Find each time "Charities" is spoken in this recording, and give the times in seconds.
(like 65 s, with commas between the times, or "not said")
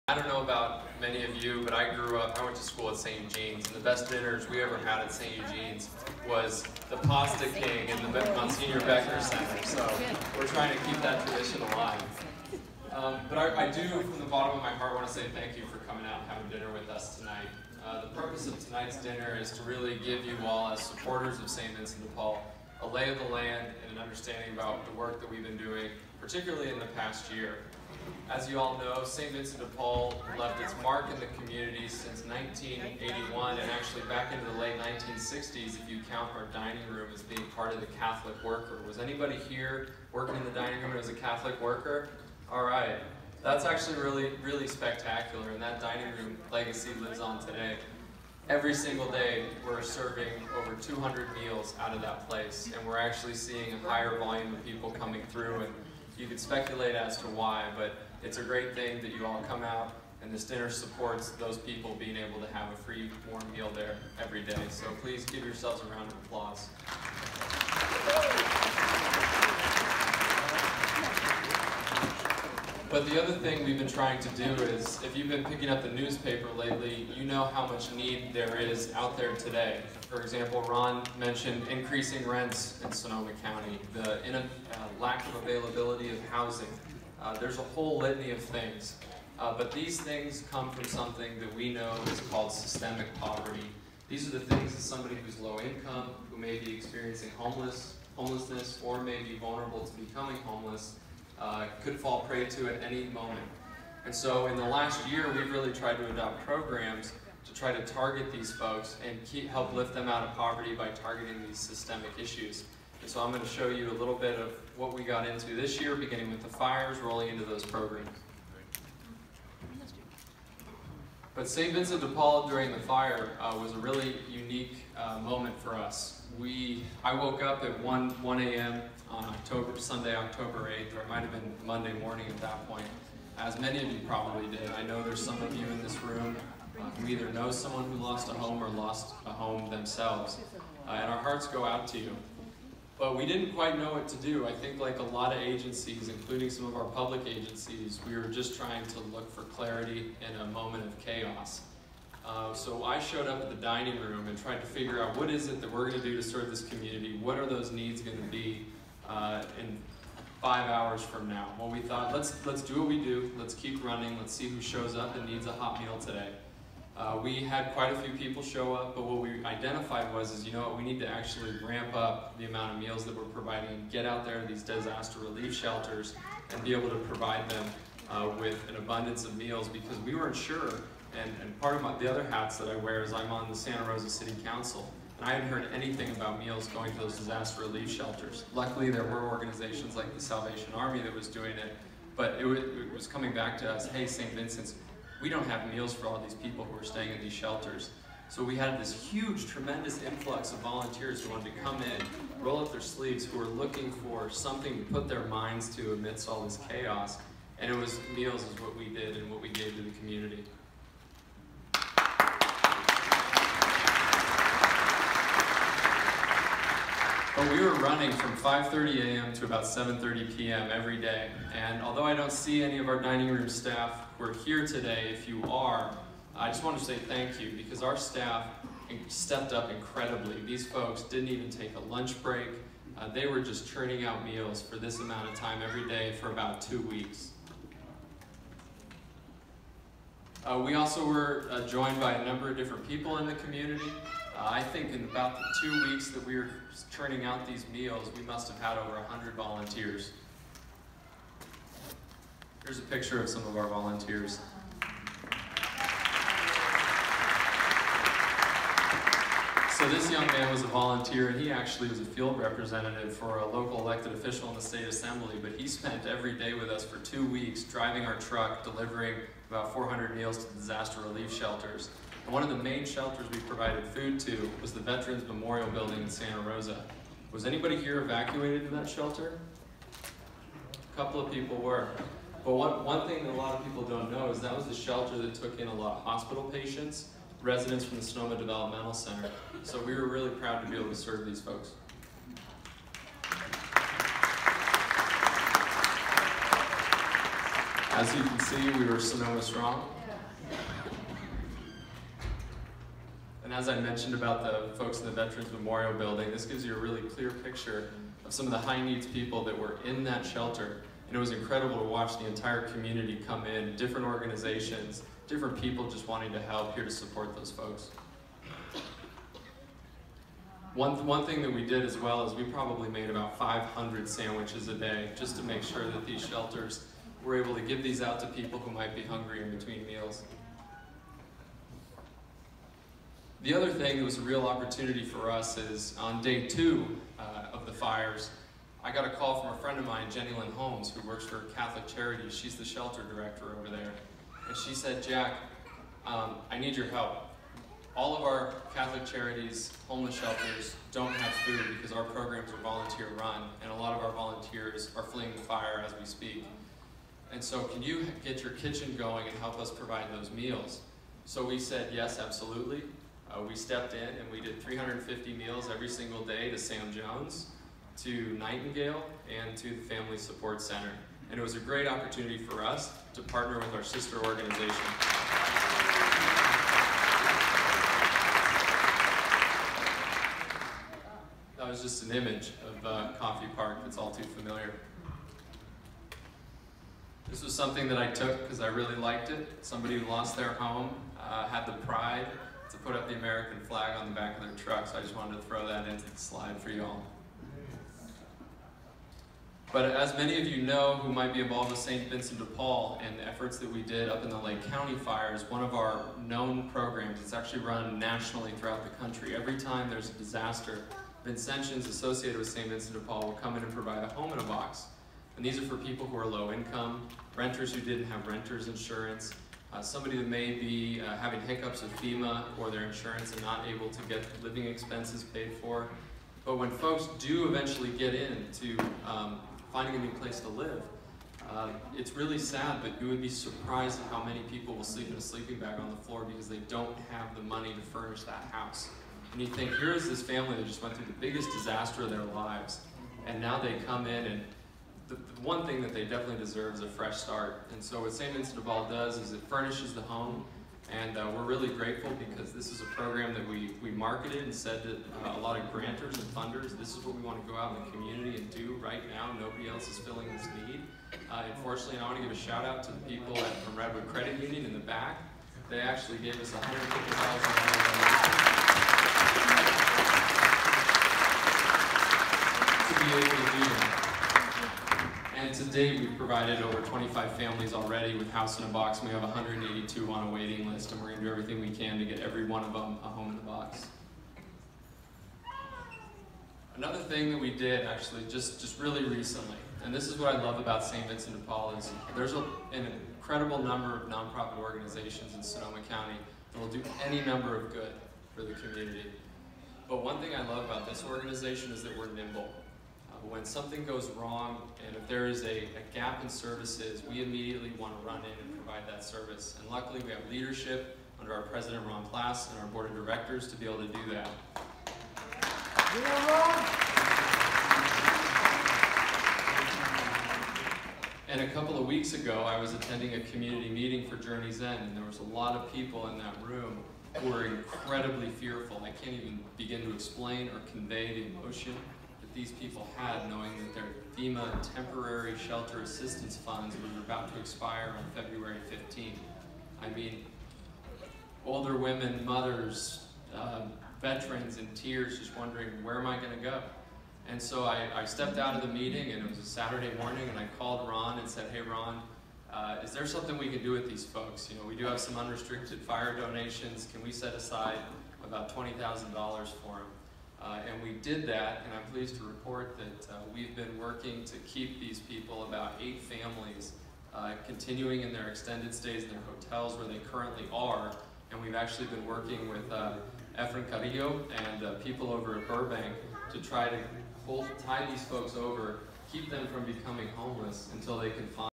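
341 s, 349 s.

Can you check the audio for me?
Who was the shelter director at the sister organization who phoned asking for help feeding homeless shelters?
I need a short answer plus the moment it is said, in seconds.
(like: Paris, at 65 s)
Jennielynn Holmes, at 340 s.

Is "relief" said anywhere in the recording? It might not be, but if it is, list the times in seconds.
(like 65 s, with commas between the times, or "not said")
175 s, 187 s, 271 s.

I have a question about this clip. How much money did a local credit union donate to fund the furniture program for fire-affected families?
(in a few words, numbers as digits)
$150,000.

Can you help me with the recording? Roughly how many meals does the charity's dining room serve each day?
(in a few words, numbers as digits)
over 200.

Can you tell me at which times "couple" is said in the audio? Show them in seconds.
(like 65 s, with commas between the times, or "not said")
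280 s, 521 s.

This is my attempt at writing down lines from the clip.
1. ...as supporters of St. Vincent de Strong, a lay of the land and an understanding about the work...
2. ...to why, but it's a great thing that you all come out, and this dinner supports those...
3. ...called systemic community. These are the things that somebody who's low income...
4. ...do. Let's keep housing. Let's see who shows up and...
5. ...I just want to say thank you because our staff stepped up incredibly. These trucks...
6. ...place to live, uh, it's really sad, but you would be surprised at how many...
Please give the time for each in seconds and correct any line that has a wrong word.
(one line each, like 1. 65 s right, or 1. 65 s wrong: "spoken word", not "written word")
1. 20 s wrong: "Paul", not "Strong"
2. 57 s right
3. 92 s wrong: "poverty", not "community"
4. 163 s wrong: "running", not "housing"
5. 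226 s wrong: "folks", not "trucks"
6. 430 s right.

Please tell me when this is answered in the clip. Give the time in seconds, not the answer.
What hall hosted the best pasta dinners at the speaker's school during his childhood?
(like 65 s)
8 s.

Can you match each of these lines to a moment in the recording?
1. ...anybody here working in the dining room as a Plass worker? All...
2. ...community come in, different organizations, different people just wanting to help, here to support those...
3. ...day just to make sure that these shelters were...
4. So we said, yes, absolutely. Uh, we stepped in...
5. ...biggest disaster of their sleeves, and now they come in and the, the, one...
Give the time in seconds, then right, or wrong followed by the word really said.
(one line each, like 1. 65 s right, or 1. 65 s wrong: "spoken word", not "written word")
1. 38 s wrong: "Catholic", not "Plass"
2. 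312 s right
3. 324 s right
4. 361 s right
5. 441 s wrong: "lives", not "sleeves".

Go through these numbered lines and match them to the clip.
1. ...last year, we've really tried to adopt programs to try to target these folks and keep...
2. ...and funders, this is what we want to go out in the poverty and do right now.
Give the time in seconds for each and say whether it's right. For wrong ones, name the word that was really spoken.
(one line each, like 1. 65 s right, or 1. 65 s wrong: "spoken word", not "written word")
1. 104 s right
2. 456 s wrong: "community", not "poverty".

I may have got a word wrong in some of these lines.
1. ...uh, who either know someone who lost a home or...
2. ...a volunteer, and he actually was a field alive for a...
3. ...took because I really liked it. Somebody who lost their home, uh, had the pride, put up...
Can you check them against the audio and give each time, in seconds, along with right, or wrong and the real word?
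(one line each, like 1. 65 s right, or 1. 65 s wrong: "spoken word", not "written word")
1. 136 s right
2. 260 s wrong: "representative", not "alive"
3. 388 s right.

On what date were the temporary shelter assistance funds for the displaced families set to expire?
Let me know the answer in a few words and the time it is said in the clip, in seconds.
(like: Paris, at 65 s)
February 15, at 538 s.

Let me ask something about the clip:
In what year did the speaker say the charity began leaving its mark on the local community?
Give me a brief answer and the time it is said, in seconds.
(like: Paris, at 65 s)
1981, at 32 s.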